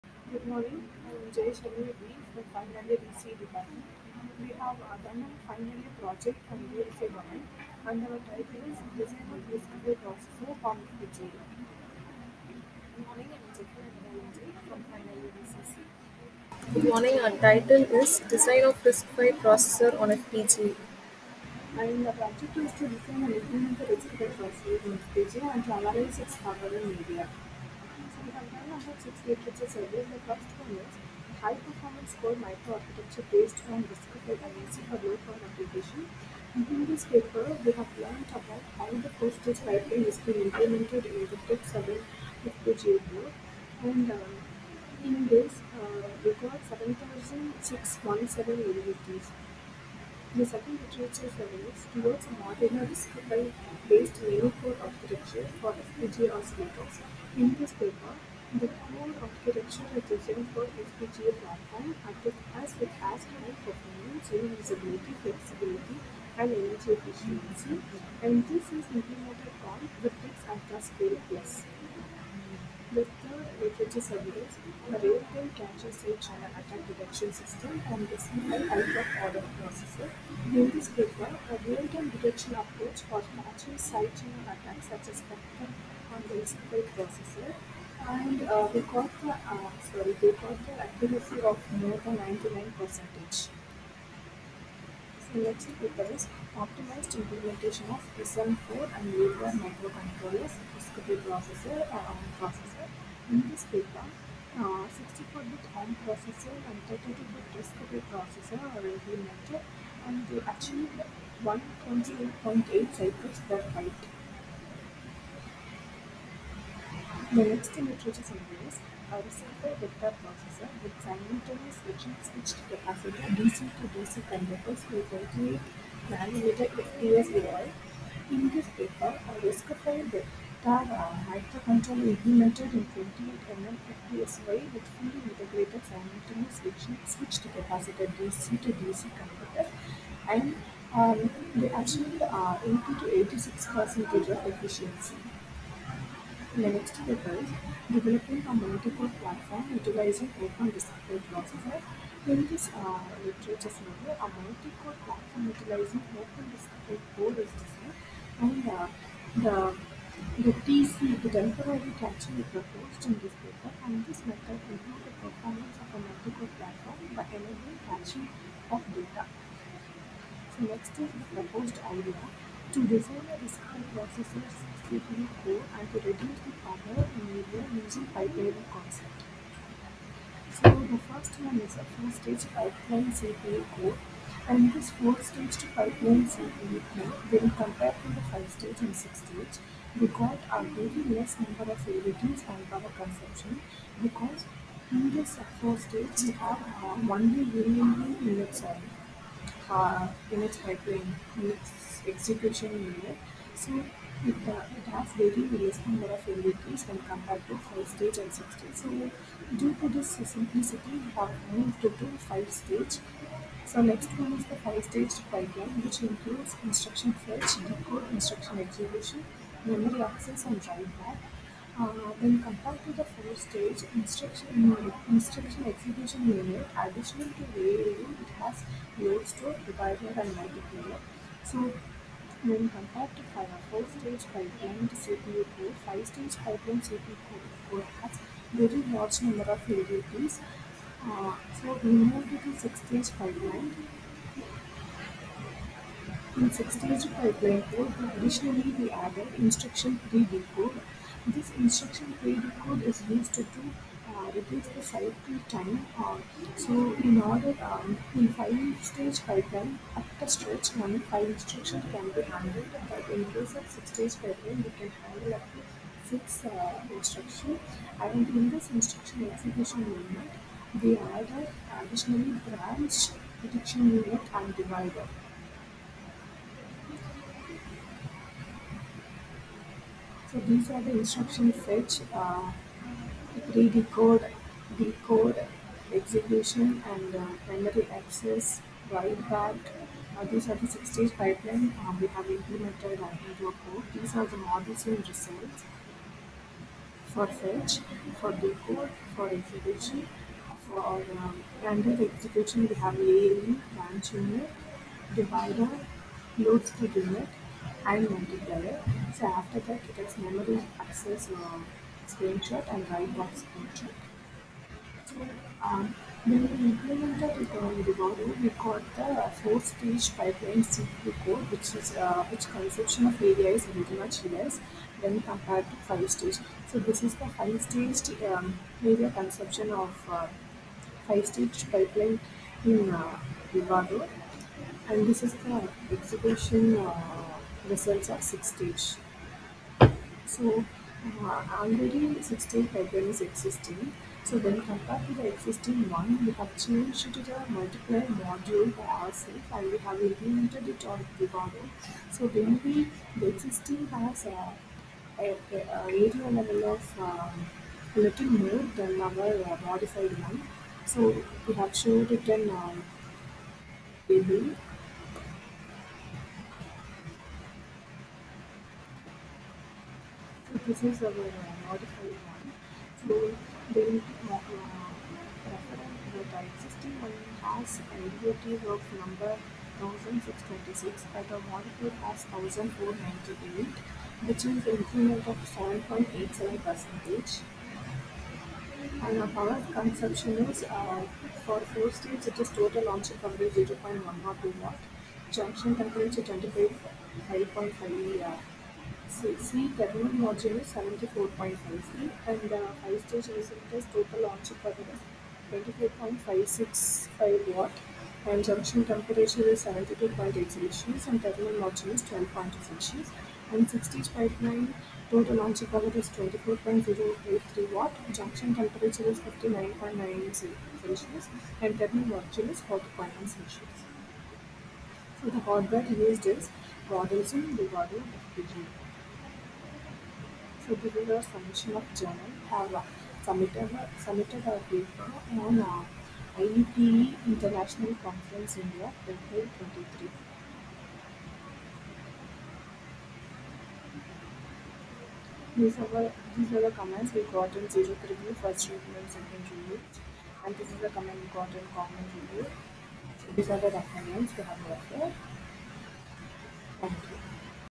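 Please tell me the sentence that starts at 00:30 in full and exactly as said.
The first years, a high performance core microarchitecture based on discovery IAC for low power application.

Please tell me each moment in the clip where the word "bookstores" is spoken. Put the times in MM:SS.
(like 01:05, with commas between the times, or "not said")
not said.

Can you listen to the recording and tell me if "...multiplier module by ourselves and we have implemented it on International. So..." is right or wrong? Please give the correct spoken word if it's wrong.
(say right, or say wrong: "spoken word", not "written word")
wrong: "Vivado", not "International".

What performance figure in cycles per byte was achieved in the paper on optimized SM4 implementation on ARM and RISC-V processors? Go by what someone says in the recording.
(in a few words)
128.8.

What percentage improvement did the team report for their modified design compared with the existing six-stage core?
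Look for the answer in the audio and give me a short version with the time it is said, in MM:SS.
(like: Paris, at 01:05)
7.87 percent, at 06:25.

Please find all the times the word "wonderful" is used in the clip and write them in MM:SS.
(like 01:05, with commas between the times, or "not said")
not said.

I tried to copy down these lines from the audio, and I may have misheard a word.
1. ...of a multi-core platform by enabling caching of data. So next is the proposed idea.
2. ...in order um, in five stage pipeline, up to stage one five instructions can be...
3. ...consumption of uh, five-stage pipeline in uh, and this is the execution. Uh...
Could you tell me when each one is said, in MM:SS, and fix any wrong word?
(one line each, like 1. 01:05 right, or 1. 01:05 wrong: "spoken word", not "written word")
1. 02:45 right
2. 04:17 right
3. 05:29 right.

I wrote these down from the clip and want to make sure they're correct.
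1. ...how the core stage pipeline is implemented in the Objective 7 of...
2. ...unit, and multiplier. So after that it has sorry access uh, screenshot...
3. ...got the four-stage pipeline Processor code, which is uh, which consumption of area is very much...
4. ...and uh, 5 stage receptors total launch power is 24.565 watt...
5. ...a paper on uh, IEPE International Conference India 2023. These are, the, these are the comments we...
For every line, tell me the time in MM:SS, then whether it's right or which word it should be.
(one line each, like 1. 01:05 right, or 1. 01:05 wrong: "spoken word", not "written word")
1. 00:38 right
2. 05:07 wrong: "memory", not "sorry"
3. 05:18 wrong: "CPU", not "Processor"
4. 06:42 right
5. 07:14 right.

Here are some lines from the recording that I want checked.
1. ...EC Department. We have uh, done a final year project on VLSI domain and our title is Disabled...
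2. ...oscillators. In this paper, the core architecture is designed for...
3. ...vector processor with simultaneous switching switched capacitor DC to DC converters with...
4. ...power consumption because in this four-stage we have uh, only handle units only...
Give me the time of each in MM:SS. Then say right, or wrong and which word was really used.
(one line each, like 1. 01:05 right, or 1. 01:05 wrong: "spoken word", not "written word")
1. 00:03 right
2. 00:56 right
3. 01:59 right
4. 03:12 wrong: "variable", not "handle".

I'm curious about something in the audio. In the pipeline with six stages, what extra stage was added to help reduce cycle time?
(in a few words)
instruction pre-decode.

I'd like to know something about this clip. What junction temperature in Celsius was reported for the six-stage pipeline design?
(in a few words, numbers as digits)
59.9.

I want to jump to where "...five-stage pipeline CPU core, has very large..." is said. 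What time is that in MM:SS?
03:55.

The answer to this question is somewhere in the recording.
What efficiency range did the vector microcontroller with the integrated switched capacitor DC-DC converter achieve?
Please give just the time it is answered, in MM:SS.
02:22.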